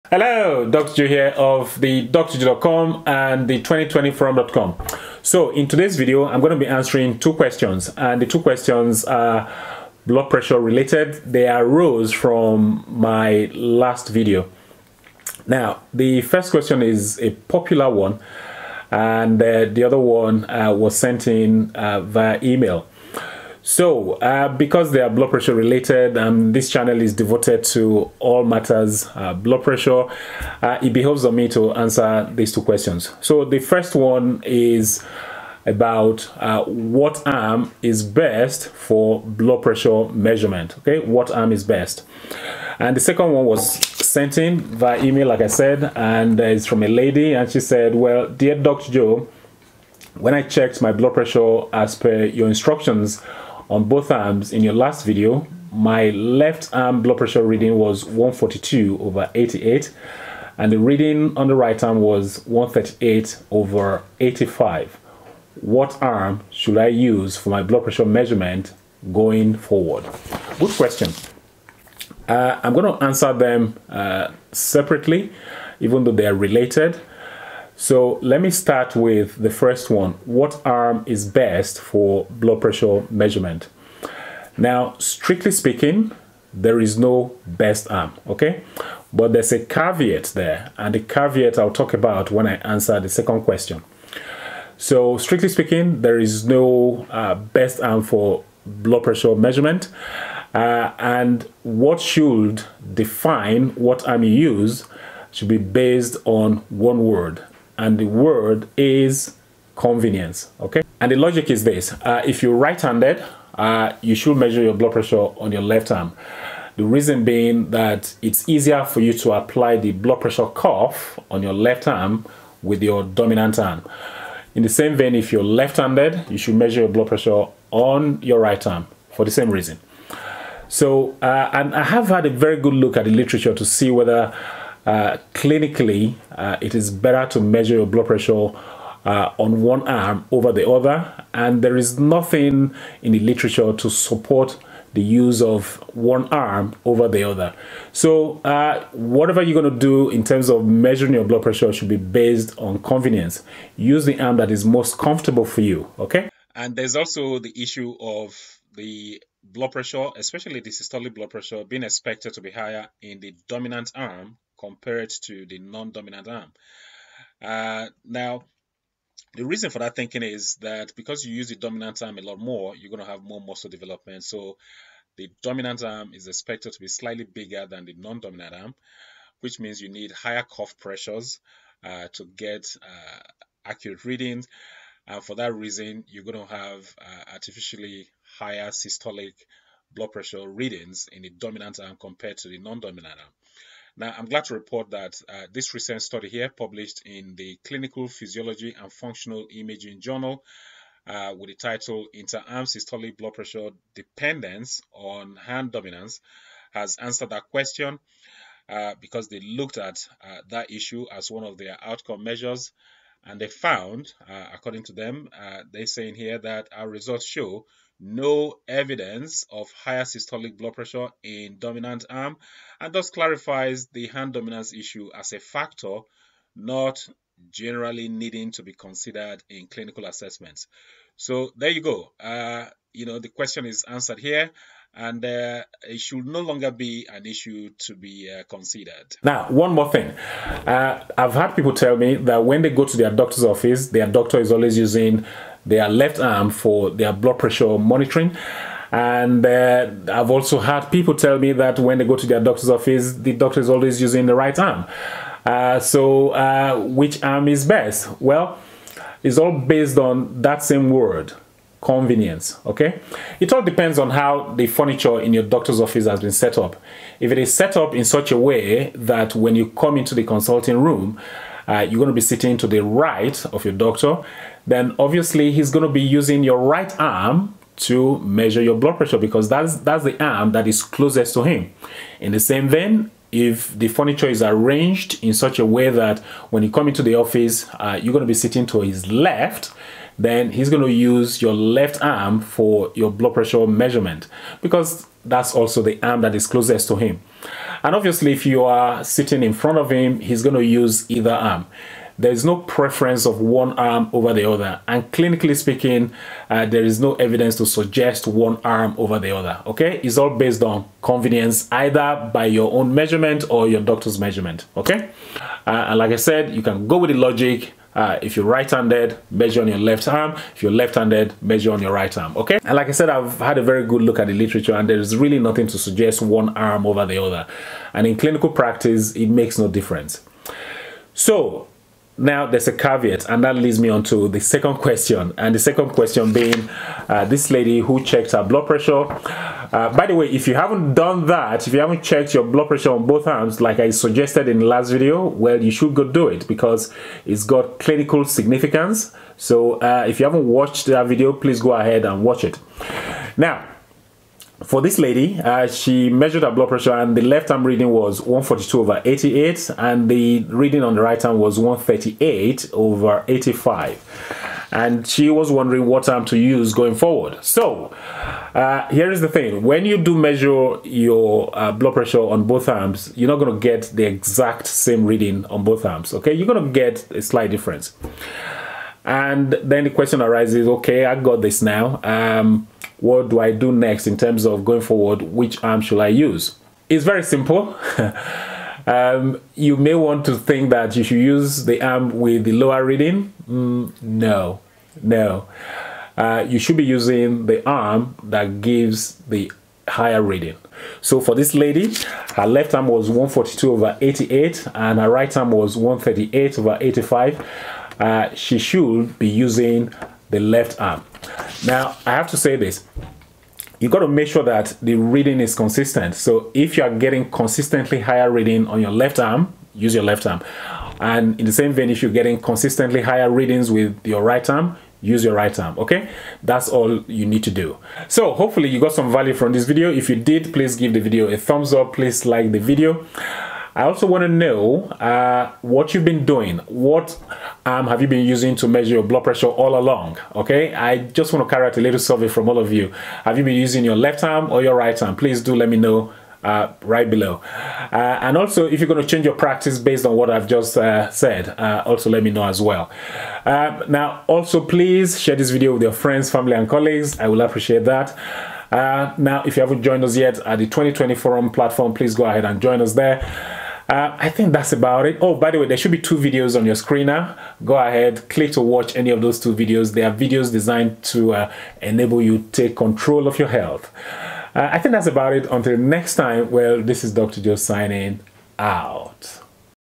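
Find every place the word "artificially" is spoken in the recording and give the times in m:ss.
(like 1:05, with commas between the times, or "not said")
3:07.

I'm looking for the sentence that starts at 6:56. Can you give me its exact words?
So if you are getting consistently higher reading on your left arm, use your left arm.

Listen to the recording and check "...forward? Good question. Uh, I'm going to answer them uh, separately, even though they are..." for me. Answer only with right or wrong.
right.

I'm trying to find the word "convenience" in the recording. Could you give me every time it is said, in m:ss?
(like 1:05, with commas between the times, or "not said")
1:49, 2:32, 4:21, 5:11.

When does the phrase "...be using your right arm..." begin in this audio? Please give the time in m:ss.
4:35.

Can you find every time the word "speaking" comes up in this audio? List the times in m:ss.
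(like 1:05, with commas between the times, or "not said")
1:25, 1:35, 5:05.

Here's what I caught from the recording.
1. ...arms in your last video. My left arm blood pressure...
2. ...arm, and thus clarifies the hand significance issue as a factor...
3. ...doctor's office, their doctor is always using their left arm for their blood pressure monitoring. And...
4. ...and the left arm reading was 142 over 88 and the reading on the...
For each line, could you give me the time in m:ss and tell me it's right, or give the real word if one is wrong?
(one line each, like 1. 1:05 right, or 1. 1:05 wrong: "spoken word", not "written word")
1. 0:54 right
2. 3:42 wrong: "dominance", not "significance"
3. 4:03 right
4. 5:56 right.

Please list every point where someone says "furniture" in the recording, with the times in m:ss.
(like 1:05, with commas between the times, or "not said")
4:24, 4:43.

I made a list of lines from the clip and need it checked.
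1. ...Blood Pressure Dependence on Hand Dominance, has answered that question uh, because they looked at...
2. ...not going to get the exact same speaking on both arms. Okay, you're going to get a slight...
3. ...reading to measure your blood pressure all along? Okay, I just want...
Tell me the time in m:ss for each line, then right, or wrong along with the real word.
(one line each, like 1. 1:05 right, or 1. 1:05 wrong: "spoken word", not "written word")
1. 3:23 right
2. 6:13 wrong: "reading", not "speaking"
3. 7:18 wrong: "using", not "reading".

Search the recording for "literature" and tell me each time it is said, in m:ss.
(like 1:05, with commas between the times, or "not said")
2:13, 2:23, 5:24.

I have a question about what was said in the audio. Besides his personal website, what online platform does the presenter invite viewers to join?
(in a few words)
2020 Forum.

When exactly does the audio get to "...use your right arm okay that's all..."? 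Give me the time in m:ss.
7:05.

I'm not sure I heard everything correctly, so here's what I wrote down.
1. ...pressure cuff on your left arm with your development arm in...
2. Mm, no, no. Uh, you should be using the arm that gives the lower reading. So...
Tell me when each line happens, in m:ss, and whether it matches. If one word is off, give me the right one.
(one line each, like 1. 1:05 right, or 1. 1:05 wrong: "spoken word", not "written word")
1. 2:00 wrong: "dominant", not "development"
2. 6:33 wrong: "higher", not "lower".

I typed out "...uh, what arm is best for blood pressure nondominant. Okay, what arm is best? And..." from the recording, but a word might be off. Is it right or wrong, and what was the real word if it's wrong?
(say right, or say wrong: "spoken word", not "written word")
wrong: "measurement", not "nondominant".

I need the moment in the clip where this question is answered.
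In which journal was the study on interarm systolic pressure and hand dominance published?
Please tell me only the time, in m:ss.
3:17.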